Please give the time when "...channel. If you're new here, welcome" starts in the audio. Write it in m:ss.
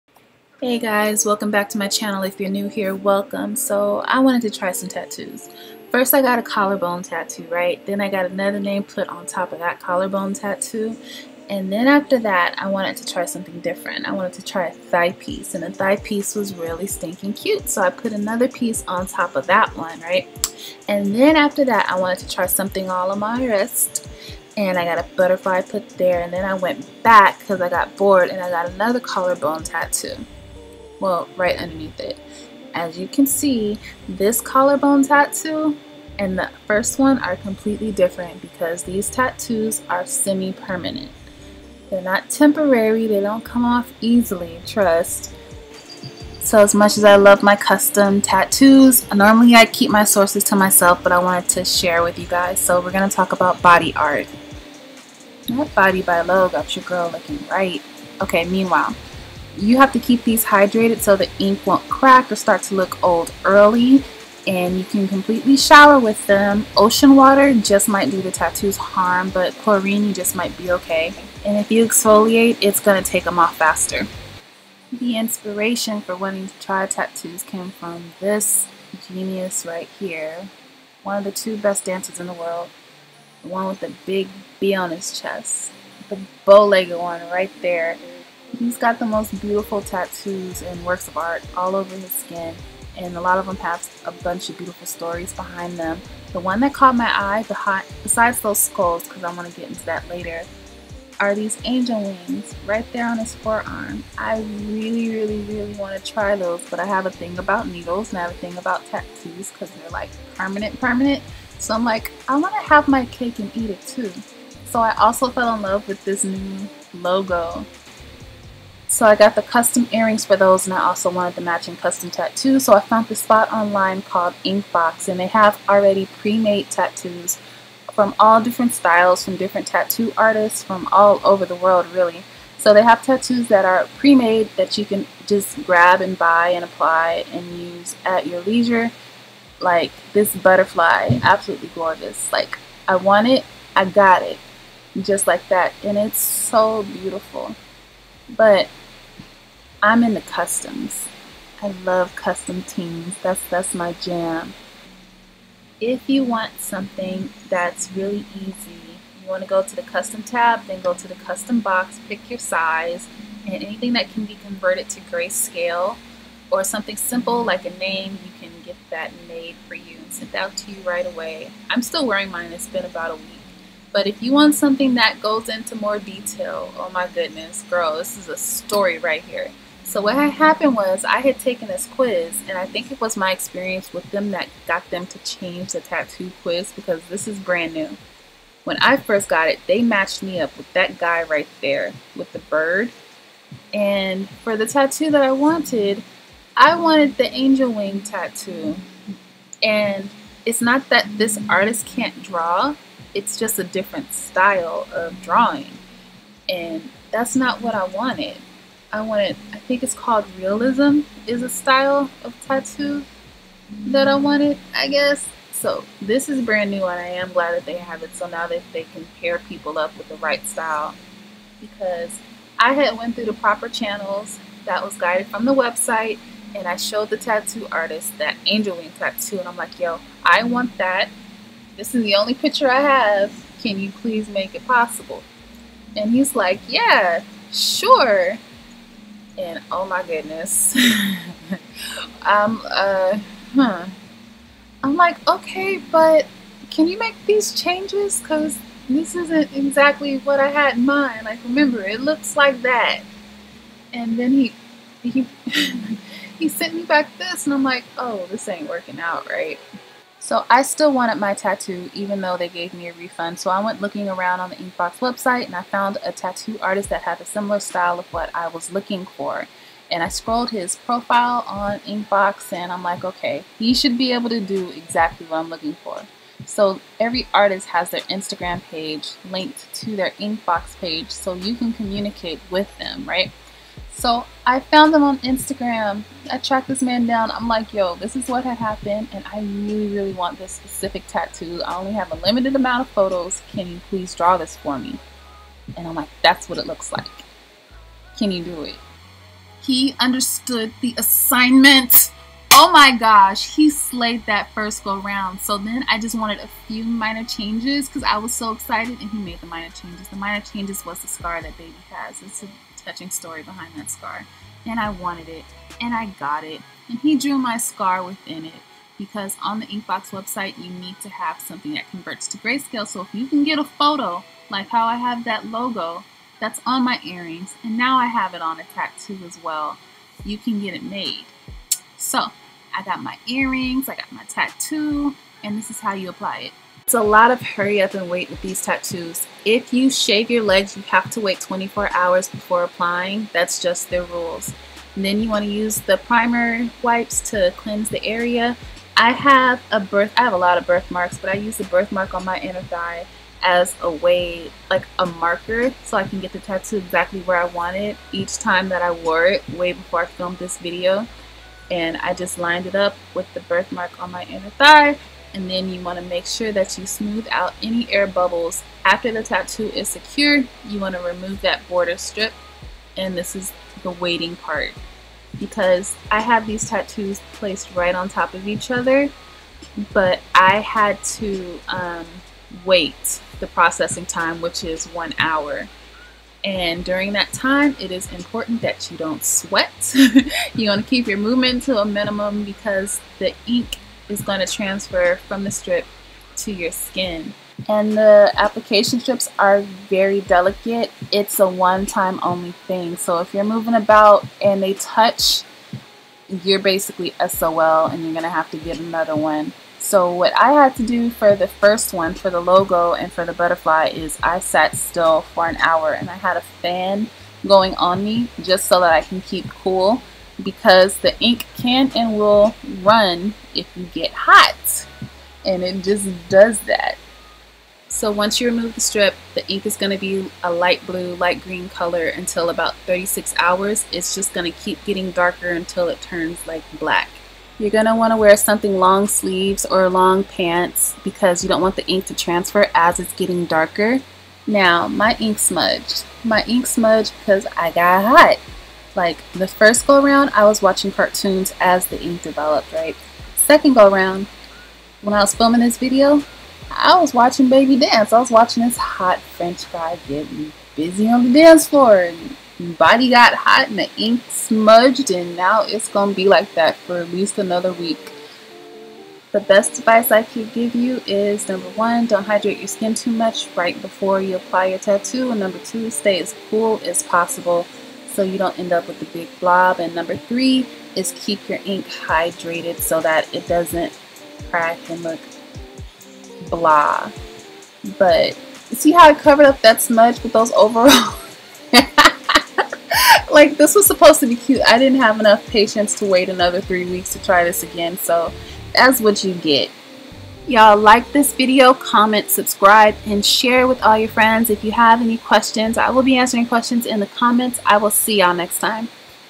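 0:01.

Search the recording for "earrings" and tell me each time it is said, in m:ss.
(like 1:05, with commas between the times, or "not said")
1:59, 5:27, 5:33.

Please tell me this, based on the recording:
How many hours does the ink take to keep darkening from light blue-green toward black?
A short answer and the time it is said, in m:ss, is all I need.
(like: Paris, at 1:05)
36 hours, at 7:12.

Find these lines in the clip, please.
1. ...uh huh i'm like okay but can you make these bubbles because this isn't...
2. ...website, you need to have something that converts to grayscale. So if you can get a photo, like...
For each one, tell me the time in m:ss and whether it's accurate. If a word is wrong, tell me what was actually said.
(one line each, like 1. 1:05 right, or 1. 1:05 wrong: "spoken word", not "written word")
1. 4:02 wrong: "changes", not "bubbles"
2. 5:20 right.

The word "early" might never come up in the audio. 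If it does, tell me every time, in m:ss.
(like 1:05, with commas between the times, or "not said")
1:03.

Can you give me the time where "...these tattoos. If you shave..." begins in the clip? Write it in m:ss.
5:38.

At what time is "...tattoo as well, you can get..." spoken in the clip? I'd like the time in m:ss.
5:28.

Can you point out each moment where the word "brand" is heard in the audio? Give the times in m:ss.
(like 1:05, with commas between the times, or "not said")
3:07, 3:36.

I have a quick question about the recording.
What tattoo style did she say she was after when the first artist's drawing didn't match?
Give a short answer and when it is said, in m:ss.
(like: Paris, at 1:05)
realism, at 3:30.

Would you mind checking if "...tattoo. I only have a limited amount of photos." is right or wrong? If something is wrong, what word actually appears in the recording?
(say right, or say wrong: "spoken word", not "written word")
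right.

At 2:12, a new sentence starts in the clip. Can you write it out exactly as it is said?
So they have tattoos that are pre-made that you can just grab and buy and apply and use at your leisure.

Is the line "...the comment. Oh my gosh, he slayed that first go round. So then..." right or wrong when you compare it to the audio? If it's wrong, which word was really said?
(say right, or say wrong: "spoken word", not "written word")
wrong: "assignment", not "comment".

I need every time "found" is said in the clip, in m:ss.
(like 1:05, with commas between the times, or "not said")
2:02, 4:25, 4:44.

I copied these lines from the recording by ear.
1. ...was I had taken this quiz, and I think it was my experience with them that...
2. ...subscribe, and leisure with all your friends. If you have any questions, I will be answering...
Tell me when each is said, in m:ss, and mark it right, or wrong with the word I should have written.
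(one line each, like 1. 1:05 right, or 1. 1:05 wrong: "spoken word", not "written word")
1. 3:00 right
2. 8:22 wrong: "share", not "leisure".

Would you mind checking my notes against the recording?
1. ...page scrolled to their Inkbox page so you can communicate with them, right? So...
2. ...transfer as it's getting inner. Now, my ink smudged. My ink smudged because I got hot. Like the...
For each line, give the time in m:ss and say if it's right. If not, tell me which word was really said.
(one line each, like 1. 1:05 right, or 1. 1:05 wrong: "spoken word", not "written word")
1. 4:38 wrong: "linked", not "scrolled"
2. 7:22 wrong: "darker", not "inner".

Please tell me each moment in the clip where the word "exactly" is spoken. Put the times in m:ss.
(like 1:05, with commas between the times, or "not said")
4:09, 4:34, 5:56.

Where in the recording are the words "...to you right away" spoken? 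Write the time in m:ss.
2:50.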